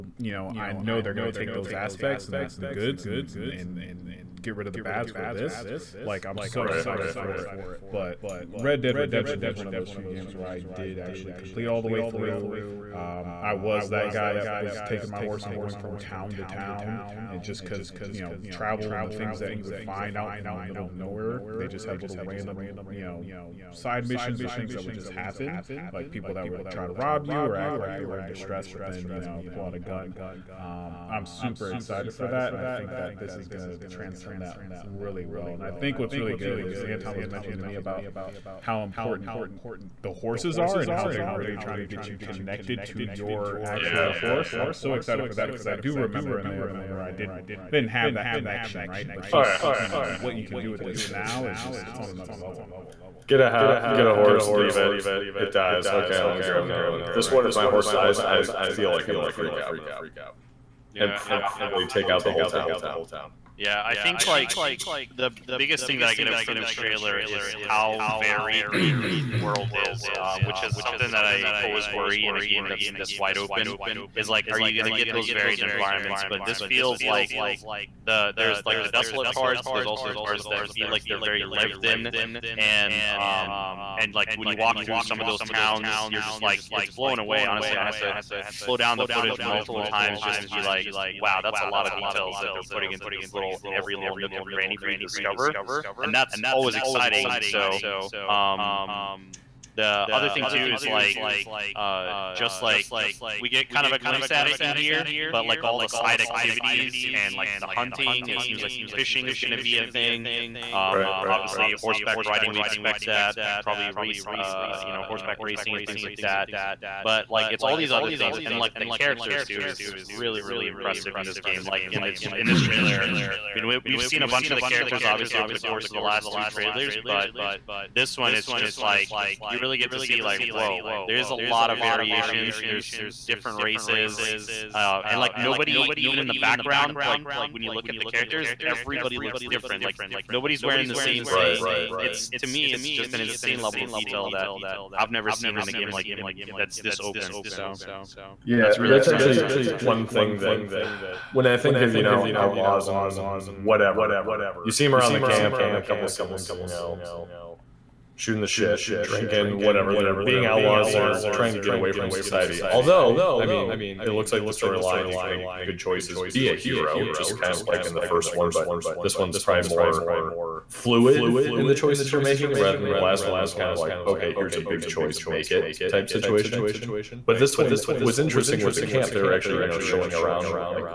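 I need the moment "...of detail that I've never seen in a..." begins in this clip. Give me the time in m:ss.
2:23.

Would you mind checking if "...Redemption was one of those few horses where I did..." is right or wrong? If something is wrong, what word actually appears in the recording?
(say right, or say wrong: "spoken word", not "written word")
wrong: "games", not "horses".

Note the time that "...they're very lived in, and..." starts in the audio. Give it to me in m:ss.
1:21.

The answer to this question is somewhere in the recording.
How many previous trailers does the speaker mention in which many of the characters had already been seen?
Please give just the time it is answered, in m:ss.
2:06.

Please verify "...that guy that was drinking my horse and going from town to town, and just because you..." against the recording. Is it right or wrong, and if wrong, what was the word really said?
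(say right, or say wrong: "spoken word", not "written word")
wrong: "taking", not "drinking".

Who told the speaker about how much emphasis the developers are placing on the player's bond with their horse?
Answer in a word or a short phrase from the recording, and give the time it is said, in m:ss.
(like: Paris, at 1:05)
Anton, at 0:36.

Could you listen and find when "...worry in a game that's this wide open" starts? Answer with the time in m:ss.
1:11.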